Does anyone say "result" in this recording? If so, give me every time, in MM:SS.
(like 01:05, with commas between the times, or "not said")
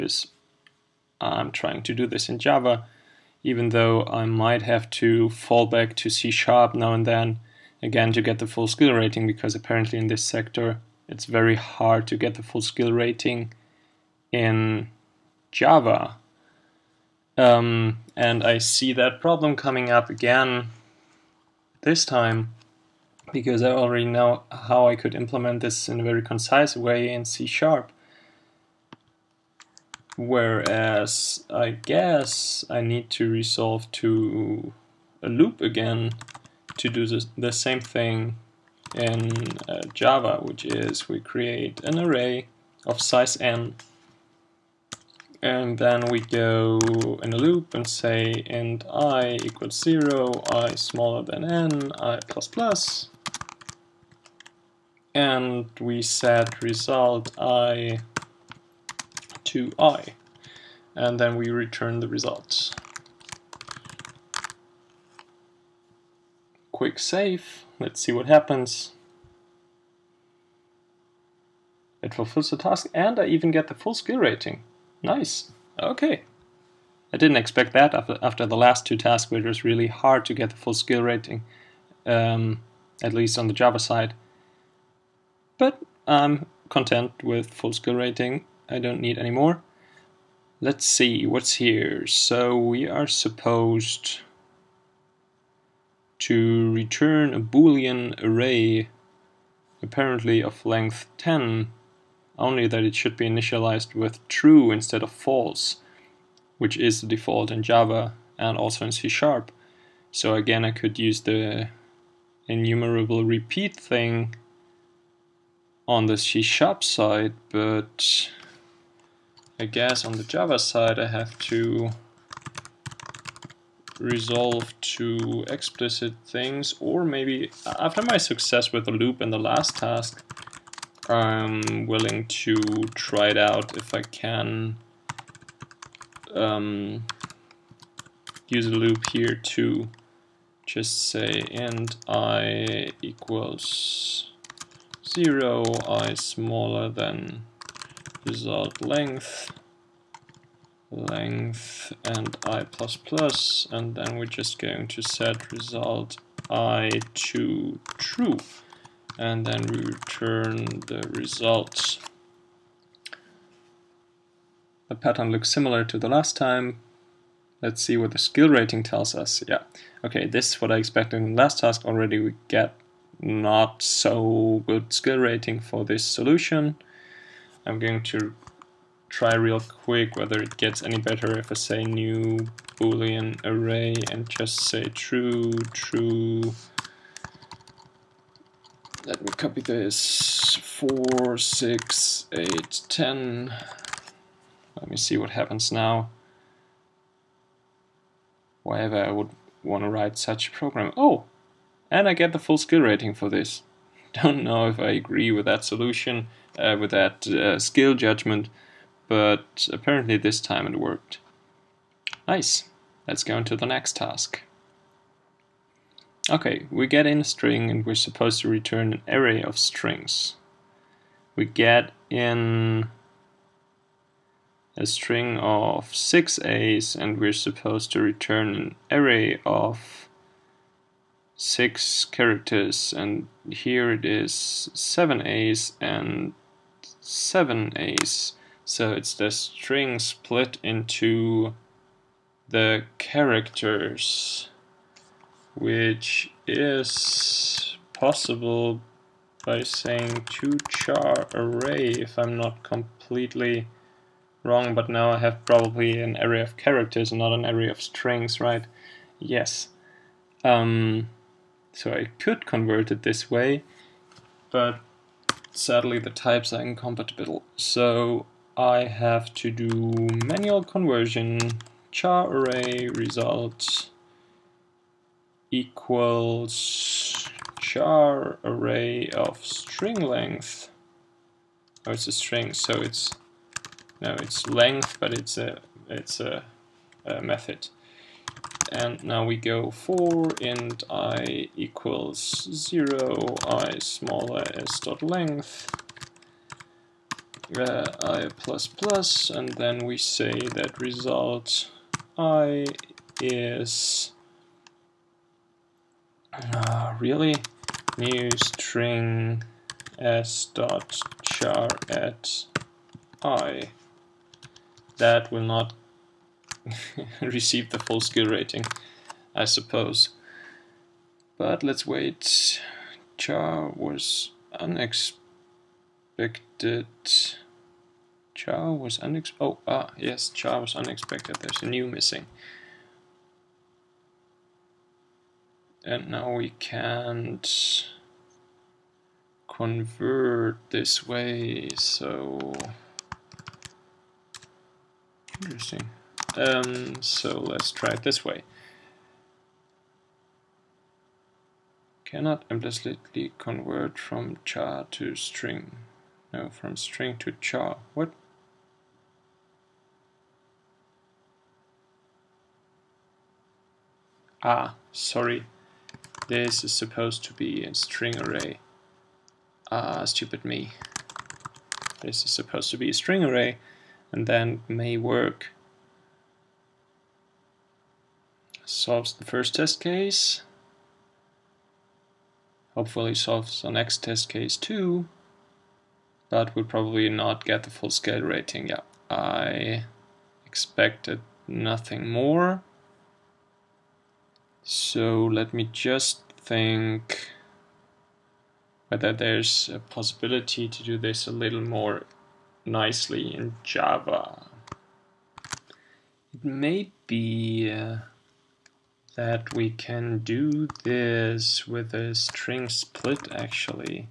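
00:56, 01:02, 02:28, 02:35, 02:41, 04:32, 05:00.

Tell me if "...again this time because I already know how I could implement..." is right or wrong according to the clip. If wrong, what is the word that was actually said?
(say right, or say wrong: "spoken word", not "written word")
right.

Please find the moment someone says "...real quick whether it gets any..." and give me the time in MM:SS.
02:59.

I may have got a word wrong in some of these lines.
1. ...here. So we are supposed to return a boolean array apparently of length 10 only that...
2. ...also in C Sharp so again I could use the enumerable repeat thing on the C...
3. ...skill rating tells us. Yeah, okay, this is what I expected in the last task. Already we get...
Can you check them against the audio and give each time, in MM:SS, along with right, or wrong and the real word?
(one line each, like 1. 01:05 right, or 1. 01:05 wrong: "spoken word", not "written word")
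1. 01:31 right
2. 01:48 right
3. 02:48 right.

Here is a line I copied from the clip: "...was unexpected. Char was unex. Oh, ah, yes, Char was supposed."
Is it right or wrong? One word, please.
wrong.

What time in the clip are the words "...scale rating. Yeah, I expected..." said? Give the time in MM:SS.
06:27.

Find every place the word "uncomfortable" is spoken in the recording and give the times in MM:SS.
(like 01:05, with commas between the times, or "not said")
not said.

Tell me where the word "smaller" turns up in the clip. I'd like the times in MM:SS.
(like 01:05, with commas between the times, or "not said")
00:50, 02:26, 04:53.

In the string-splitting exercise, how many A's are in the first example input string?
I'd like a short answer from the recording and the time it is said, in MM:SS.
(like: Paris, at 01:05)
6, at 03:45.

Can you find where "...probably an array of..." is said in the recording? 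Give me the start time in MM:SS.
04:15.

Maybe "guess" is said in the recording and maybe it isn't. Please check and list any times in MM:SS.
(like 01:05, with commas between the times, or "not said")
00:31, 01:59.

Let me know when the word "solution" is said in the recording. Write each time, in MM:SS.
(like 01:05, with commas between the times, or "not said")
02:56, 03:25.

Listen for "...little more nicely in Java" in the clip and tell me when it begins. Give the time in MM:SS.
06:41.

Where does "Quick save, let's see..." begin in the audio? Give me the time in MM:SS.
01:06.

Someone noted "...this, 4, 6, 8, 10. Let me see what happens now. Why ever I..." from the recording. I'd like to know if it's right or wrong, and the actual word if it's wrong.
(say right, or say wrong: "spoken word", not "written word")
right.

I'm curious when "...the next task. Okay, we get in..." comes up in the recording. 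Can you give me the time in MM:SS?
03:33.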